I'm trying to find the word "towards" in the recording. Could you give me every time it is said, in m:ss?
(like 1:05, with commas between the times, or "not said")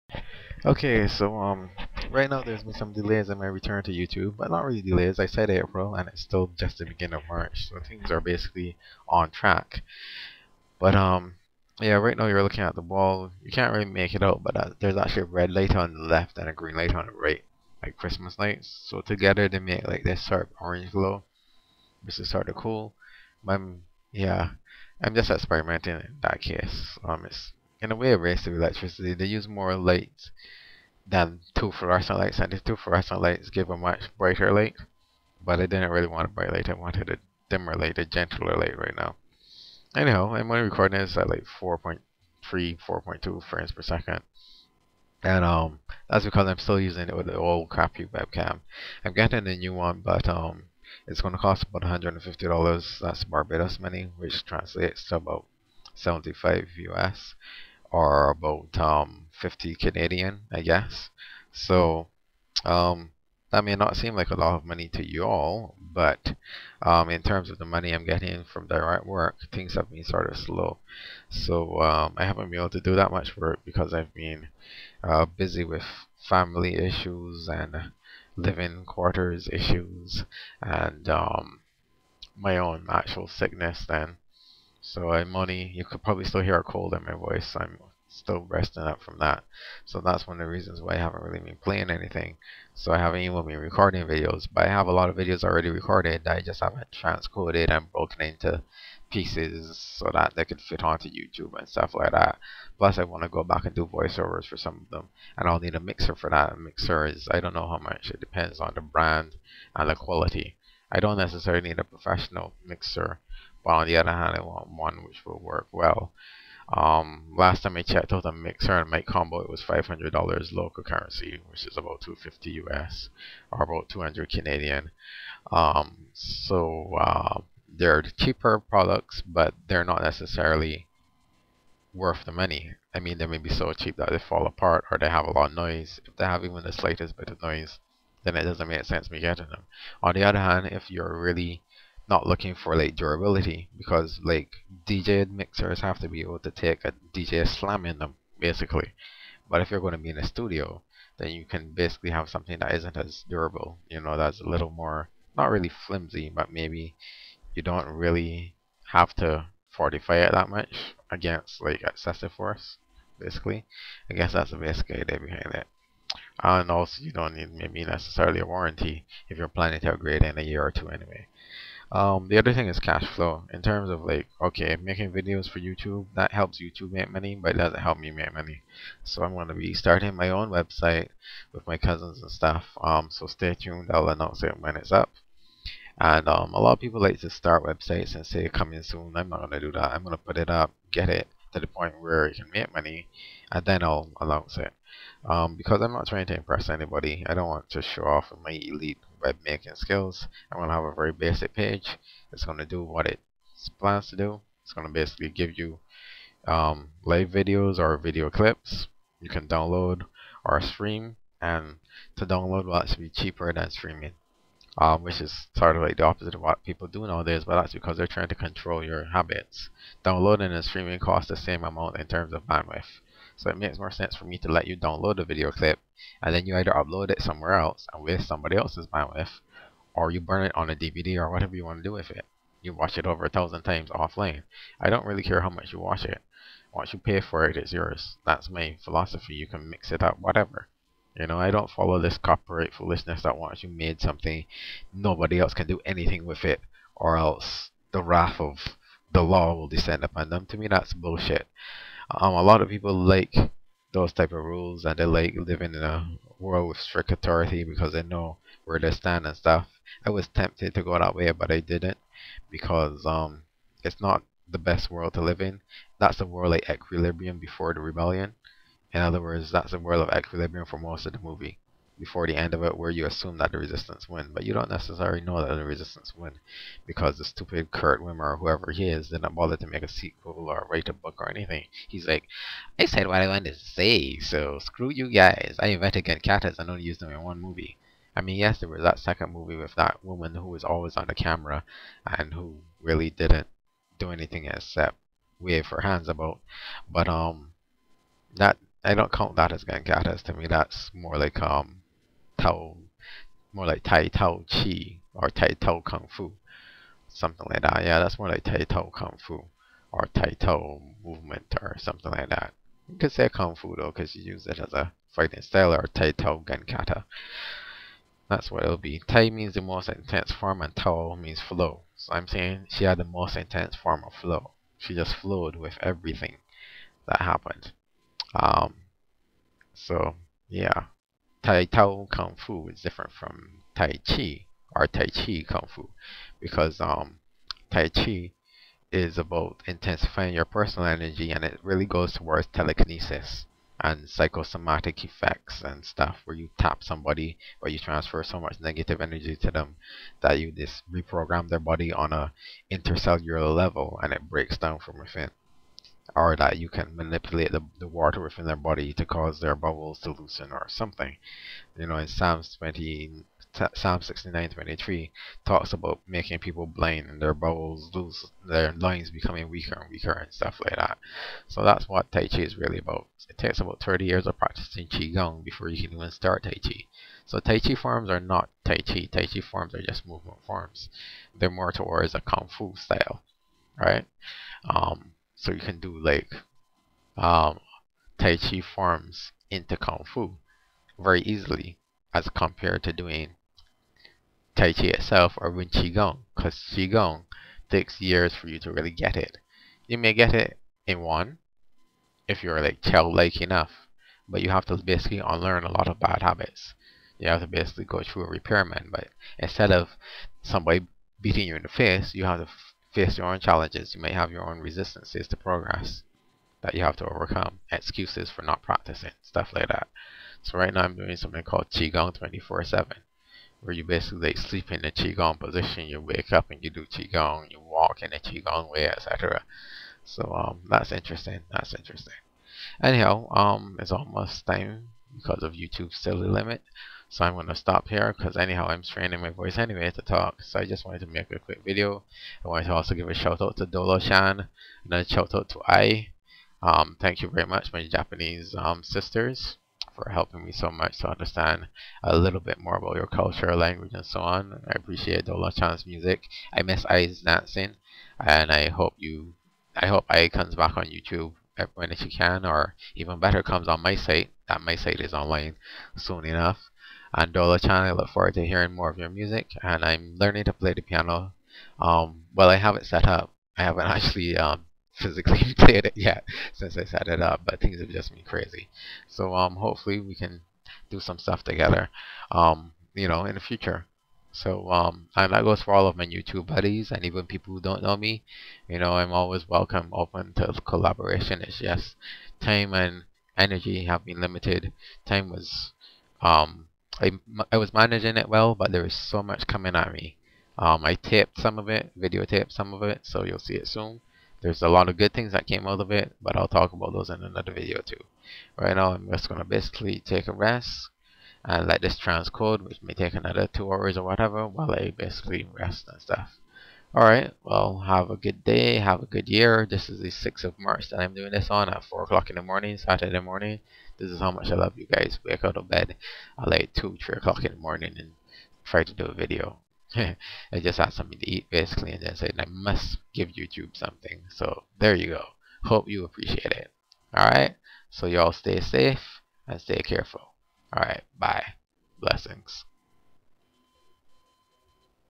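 5:42, 6:21.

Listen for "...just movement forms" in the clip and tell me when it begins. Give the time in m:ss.
6:19.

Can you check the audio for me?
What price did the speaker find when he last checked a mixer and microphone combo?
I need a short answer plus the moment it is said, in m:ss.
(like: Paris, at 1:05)
$500, at 1:59.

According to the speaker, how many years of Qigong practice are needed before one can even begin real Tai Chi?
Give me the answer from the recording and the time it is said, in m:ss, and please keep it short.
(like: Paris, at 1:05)
30, at 6:13.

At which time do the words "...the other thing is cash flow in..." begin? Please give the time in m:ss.
2:52.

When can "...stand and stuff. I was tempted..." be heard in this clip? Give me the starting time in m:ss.
4:18.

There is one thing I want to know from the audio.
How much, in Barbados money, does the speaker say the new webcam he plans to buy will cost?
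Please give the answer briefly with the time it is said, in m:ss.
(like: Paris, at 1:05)
$150, at 0:52.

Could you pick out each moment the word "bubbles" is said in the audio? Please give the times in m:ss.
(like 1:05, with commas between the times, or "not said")
5:59, 6:07.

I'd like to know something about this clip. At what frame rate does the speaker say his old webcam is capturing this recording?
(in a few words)
4.3 frames per second.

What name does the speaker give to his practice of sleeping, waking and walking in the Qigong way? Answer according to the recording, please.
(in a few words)
Qigong 24-7.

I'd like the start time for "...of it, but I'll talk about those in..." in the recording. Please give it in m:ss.
8:25.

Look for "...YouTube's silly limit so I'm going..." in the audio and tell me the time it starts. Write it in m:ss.
7:15.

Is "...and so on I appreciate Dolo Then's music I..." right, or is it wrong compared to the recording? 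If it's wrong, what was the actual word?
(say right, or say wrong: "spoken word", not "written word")
wrong: "Chan", not "Then".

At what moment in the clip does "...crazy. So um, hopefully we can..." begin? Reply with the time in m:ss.
7:58.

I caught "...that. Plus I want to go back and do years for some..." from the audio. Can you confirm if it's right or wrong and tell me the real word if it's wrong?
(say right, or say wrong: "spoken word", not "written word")
wrong: "voiceovers", not "years".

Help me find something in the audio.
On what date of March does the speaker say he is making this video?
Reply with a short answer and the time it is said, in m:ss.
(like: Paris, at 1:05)
6th of March, at 8:40.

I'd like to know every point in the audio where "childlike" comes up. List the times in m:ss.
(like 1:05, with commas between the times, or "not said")
6:42.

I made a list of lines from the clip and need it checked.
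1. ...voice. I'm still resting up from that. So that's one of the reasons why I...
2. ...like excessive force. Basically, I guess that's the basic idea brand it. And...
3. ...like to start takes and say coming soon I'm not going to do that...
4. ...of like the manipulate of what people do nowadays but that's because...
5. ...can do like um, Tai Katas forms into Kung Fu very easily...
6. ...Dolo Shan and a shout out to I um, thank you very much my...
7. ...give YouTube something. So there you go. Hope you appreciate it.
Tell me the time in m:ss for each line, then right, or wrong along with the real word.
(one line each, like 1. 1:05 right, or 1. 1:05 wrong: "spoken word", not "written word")
1. 1:27 right
2. 2:41 wrong: "behind", not "brand"
3. 3:07 wrong: "websites", not "takes"
4. 3:35 wrong: "opposite", not "manipulate"
5. 6:25 wrong: "Chi", not "Katas"
6. 7:23 right
7. 8:53 right.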